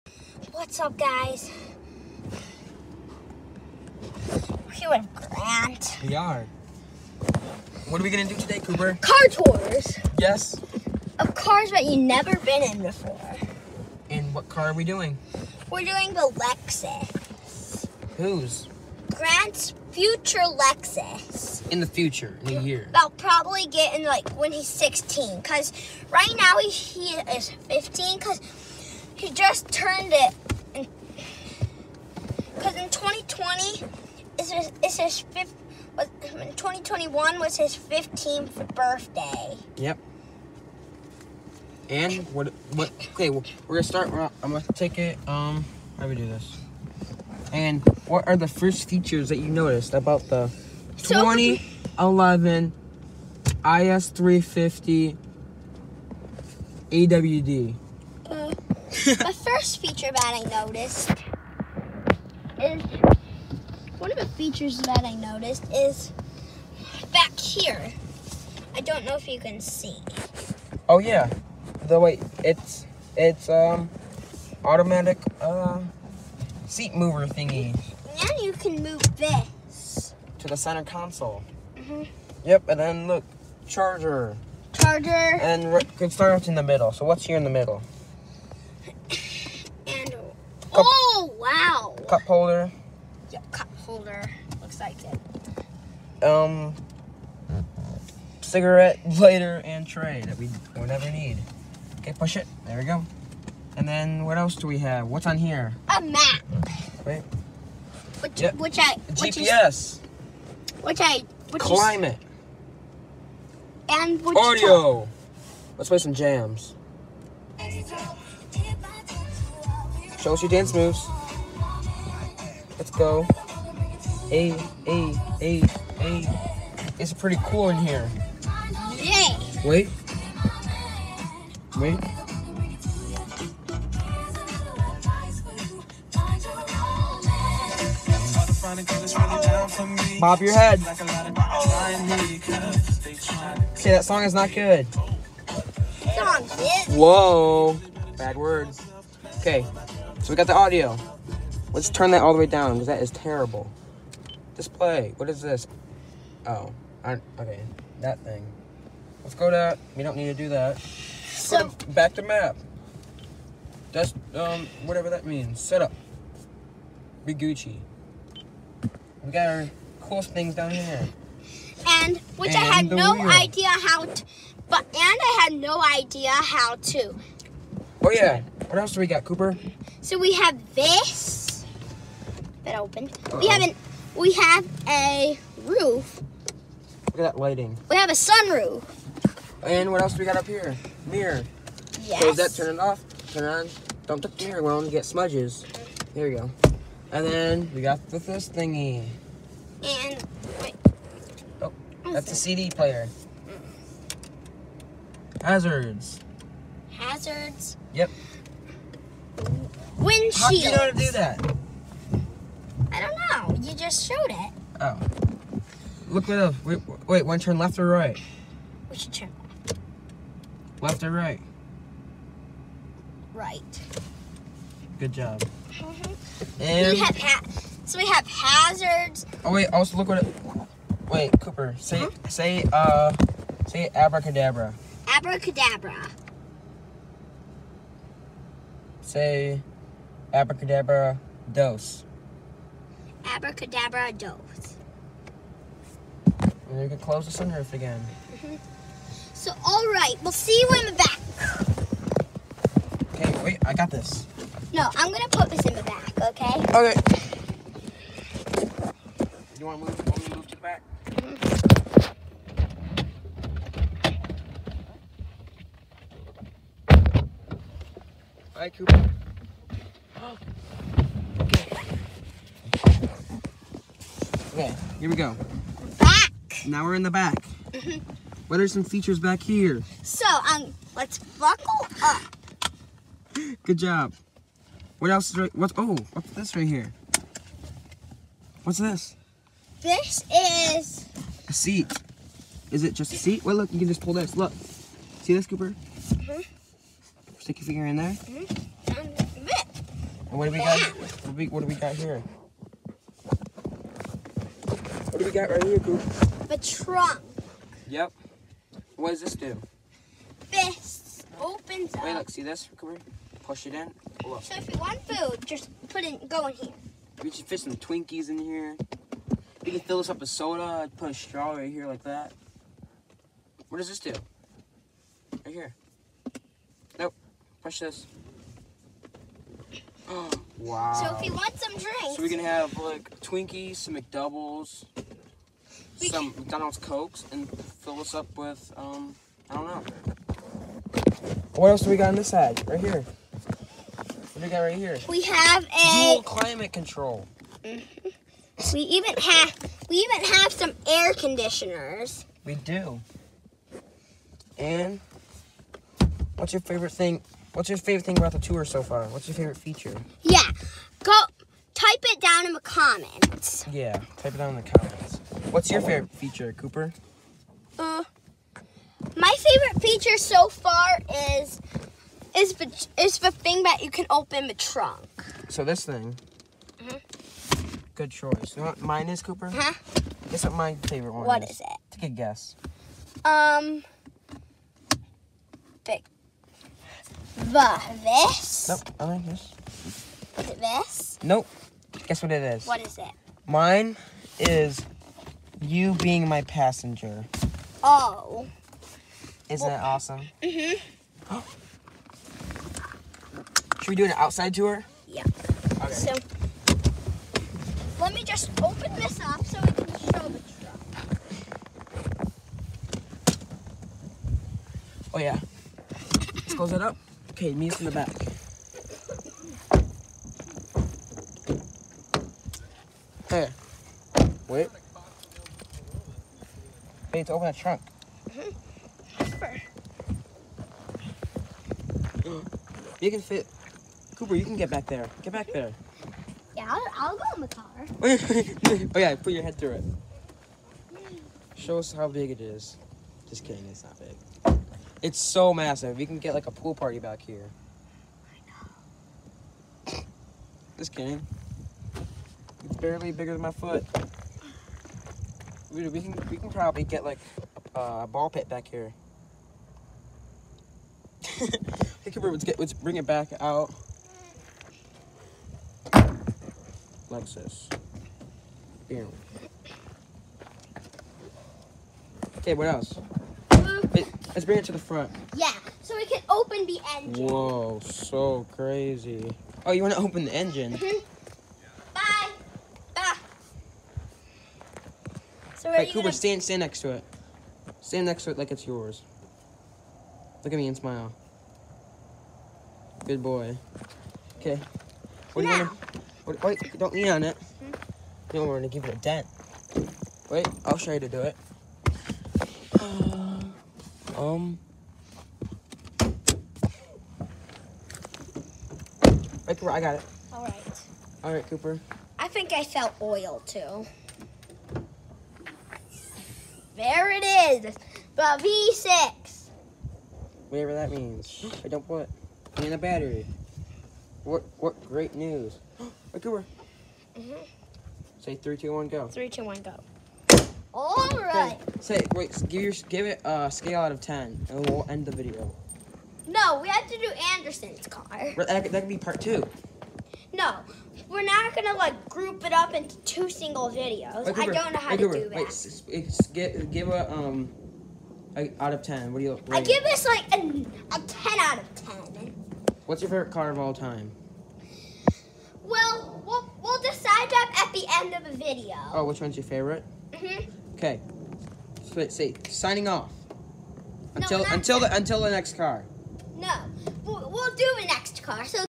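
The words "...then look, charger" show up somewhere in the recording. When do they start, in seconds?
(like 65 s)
82 s.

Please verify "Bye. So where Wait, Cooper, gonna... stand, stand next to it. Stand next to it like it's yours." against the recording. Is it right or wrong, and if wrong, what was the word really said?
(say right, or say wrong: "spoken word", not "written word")
right.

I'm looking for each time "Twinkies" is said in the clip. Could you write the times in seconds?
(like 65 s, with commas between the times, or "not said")
317 s, 333 s.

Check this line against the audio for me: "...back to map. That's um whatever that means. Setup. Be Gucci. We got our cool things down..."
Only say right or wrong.
right.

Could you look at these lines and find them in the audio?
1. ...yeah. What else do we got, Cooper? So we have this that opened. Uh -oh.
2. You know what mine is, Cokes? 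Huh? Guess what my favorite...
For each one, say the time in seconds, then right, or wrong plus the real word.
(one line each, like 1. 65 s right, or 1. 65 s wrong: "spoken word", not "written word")
1. 178 s right
2. 378 s wrong: "Cooper", not "Cokes".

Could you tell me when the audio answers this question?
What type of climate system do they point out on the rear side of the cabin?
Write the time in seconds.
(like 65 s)
346 s.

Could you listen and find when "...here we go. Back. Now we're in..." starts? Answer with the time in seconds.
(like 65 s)
274 s.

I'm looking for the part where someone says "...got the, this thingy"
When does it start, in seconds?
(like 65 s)
197 s.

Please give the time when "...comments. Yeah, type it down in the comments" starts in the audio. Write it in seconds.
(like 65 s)
362 s.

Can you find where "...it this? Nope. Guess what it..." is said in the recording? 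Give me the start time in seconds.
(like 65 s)
390 s.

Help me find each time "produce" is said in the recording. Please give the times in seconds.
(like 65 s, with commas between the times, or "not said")
not said.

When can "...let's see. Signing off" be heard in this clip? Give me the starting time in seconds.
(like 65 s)
561 s.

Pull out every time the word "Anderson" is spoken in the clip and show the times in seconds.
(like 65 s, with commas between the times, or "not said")
537 s.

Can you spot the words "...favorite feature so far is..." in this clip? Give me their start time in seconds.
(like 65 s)
369 s.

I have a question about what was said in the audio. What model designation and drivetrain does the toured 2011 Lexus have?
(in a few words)
IS350 AWD.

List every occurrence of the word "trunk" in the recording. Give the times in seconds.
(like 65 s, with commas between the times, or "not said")
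306 s, 374 s, 427 s.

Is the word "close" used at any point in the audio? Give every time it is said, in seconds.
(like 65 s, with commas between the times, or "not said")
192 s, 246 s, 416 s.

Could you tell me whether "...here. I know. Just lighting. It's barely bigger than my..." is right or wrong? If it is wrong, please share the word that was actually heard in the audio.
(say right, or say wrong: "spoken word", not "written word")
wrong: "kidding", not "lighting".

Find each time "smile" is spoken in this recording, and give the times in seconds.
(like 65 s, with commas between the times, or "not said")
490 s.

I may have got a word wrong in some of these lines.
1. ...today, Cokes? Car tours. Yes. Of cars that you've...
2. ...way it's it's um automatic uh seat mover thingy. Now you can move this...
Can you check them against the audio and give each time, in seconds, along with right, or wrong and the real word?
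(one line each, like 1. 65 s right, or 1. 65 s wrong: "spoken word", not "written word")
1. 8 s wrong: "Cooper", not "Cokes"
2. 72 s right.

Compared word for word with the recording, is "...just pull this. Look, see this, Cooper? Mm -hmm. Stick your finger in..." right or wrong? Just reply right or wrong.
right.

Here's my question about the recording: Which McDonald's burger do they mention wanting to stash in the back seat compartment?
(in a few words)
McDoubles.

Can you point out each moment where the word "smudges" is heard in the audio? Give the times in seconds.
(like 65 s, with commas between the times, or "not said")
195 s.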